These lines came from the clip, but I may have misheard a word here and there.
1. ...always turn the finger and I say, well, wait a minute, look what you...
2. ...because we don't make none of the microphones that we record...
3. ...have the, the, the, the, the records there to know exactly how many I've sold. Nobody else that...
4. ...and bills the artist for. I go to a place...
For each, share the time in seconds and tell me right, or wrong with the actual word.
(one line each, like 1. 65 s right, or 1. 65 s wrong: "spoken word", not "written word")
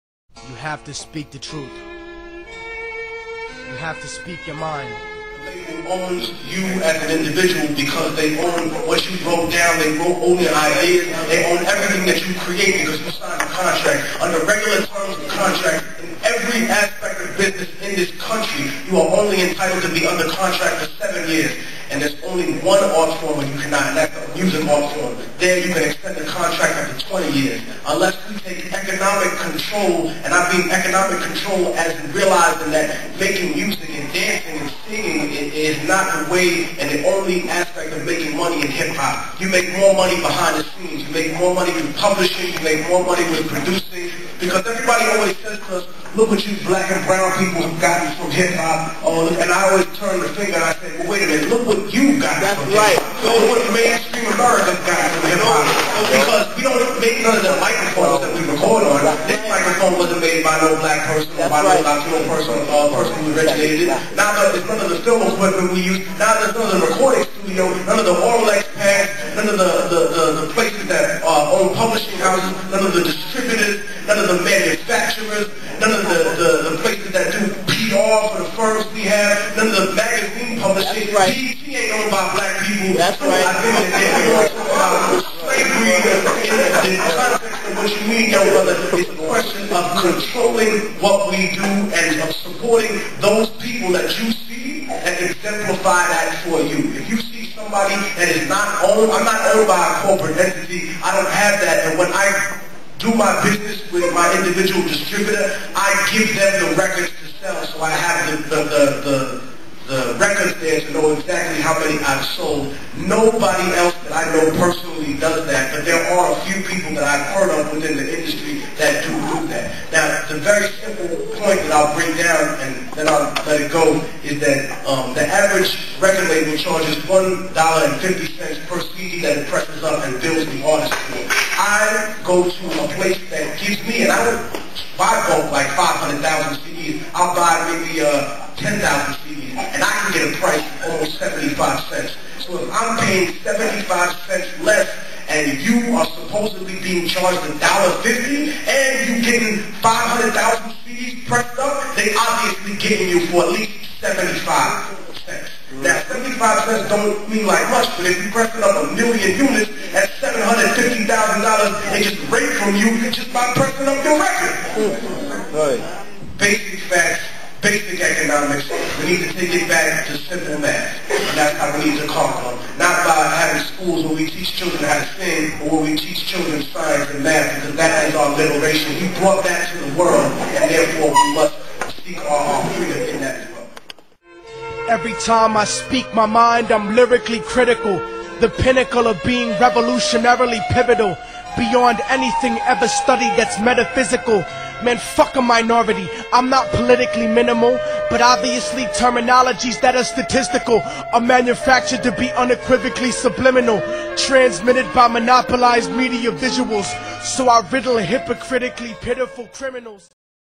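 1. 49 s right
2. 56 s right
3. 107 s right
4. 130 s right.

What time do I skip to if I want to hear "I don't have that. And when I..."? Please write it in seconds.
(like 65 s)
101 s.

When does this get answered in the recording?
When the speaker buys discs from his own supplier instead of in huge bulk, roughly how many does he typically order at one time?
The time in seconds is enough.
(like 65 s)
138 s.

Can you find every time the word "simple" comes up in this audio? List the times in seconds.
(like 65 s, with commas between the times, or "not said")
120 s, 170 s.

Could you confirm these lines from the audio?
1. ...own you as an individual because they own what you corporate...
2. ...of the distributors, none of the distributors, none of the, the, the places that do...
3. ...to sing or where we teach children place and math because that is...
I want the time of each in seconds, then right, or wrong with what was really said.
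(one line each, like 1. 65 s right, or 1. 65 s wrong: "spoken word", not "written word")
1. 5 s wrong: "wrote", not "corporate"
2. 72 s wrong: "manufacturers", not "distributors"
3. 174 s wrong: "science", not "place".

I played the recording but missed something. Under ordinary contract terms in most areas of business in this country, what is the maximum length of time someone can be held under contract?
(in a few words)
7 years.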